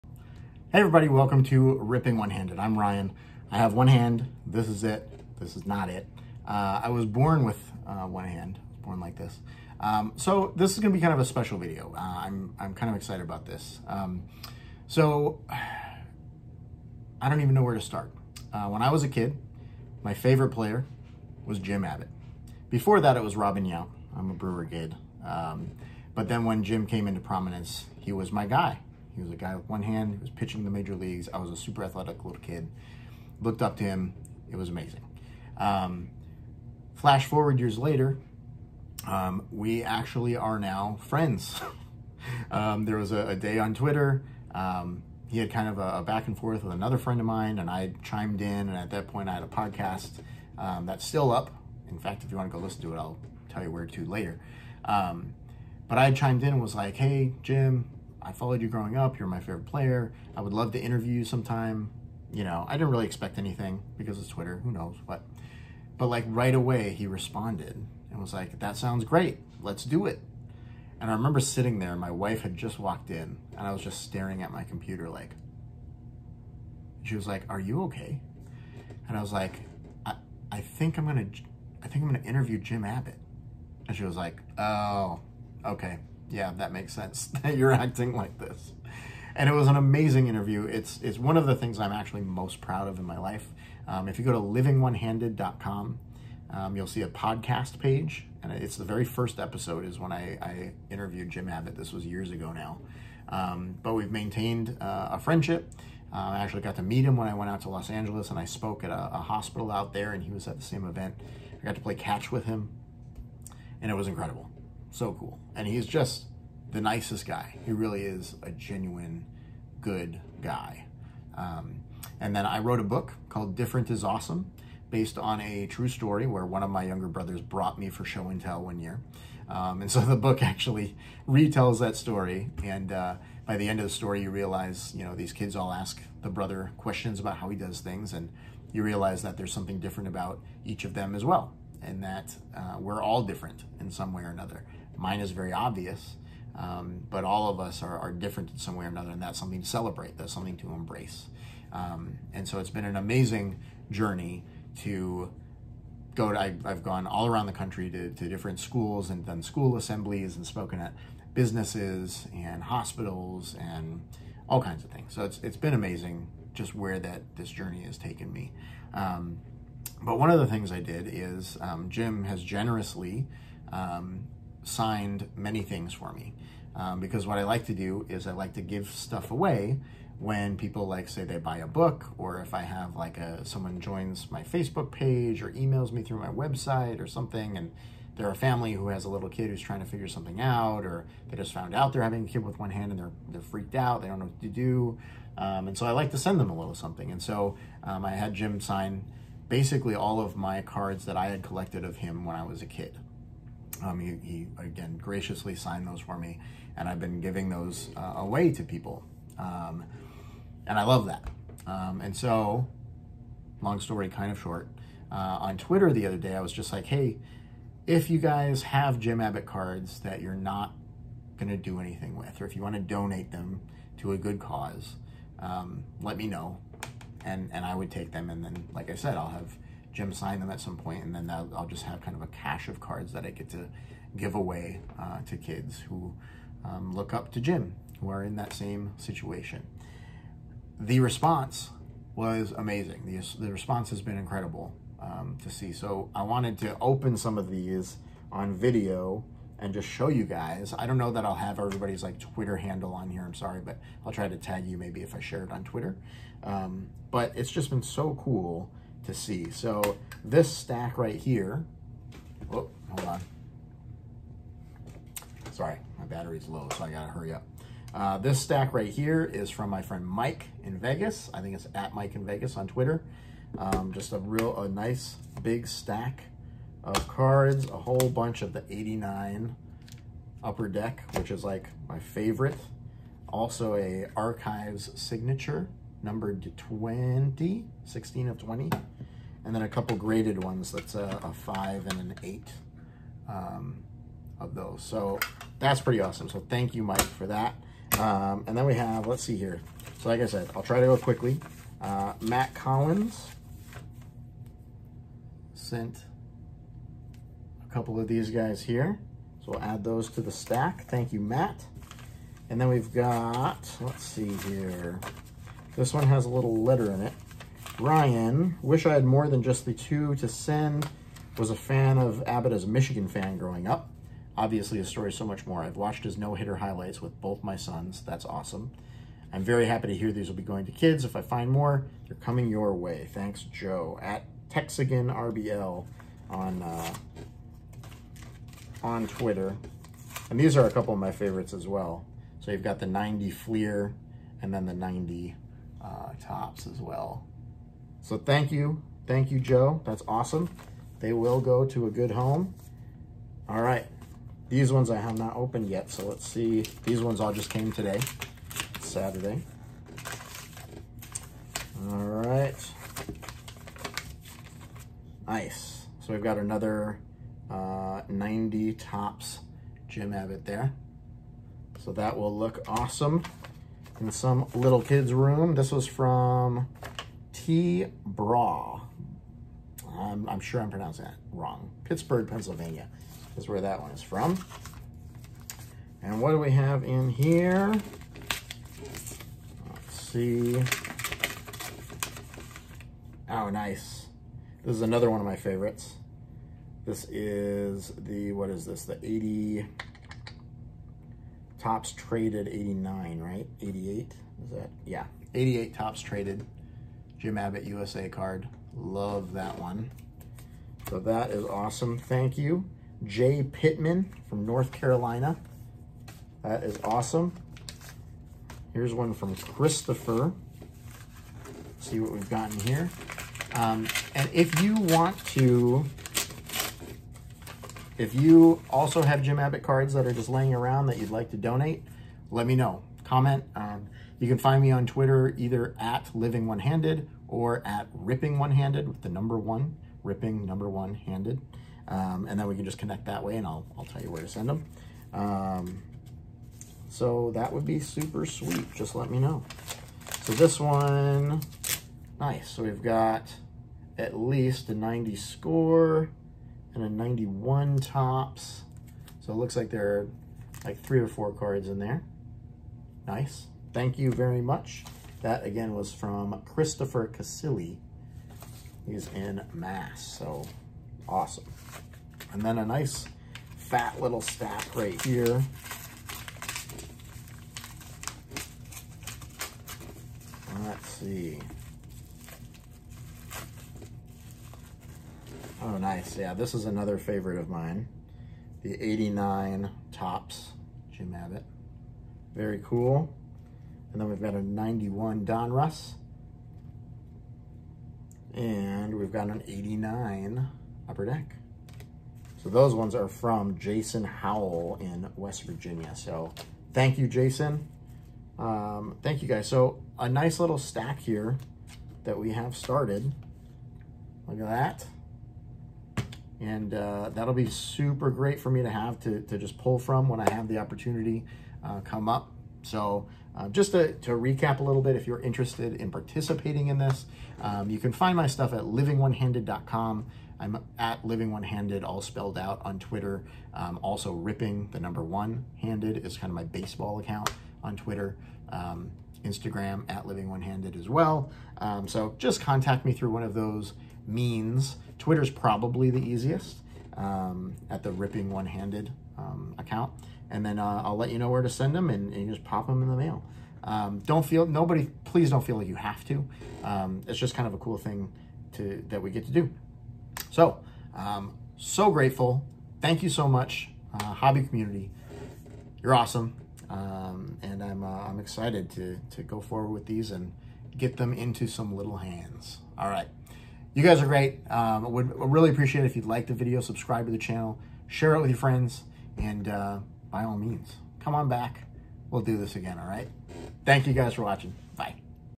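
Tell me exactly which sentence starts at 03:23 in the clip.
Um, he, he, again, graciously signed those for me, and I've been giving those uh, away to people.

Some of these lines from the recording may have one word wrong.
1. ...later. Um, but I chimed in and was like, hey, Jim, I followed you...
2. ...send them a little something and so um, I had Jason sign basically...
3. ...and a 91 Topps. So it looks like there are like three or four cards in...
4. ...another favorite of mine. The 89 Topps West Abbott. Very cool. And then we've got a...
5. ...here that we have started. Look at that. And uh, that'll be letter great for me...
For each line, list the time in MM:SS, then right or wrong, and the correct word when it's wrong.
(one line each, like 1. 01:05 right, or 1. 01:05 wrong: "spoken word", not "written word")
1. 00:54 right
2. 03:16 wrong: "Jim", not "Jason"
3. 07:36 right
4. 08:06 wrong: "Jim", not "West"
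5. 08:30 wrong: "super", not "letter".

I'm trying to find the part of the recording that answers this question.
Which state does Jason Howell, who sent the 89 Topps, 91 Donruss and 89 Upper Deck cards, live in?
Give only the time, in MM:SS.
08:25.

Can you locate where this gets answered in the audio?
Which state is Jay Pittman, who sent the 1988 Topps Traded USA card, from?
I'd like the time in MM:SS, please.
06:54.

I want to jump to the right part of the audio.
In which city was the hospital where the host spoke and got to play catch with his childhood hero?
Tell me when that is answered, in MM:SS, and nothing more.
01:47.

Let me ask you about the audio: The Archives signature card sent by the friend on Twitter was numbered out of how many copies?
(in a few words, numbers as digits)
20.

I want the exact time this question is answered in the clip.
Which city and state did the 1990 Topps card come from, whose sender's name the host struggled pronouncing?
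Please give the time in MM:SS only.
06:21.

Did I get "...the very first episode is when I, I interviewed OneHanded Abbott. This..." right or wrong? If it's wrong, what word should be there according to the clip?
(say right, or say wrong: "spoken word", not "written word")
wrong: "Jim", not "OneHanded".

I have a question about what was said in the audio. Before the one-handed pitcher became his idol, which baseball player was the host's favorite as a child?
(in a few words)
Robin Yount.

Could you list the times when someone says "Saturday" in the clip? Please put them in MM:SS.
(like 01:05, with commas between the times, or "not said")
05:58.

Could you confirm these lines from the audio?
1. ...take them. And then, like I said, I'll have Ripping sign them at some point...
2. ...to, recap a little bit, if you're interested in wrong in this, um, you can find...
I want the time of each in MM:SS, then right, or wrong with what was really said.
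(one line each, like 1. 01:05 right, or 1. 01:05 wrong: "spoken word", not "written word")
1. 03:47 wrong: "Jim", not "Ripping"
2. 08:43 wrong: "participating", not "wrong".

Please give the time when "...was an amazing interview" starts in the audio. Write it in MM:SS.
01:29.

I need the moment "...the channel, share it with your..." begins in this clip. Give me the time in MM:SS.
09:37.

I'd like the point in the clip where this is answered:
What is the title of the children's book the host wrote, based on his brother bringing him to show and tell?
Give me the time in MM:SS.
02:03.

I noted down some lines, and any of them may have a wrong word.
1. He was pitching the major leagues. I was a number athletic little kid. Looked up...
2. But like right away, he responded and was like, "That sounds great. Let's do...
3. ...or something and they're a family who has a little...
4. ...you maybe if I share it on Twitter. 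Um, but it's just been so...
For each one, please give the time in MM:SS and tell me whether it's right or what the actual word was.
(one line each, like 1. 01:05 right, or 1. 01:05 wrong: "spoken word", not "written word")
1. 00:30 wrong: "super", not "number"
2. 01:05 right
3. 03:07 right
4. 04:14 right.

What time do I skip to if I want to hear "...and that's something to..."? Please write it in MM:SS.
02:29.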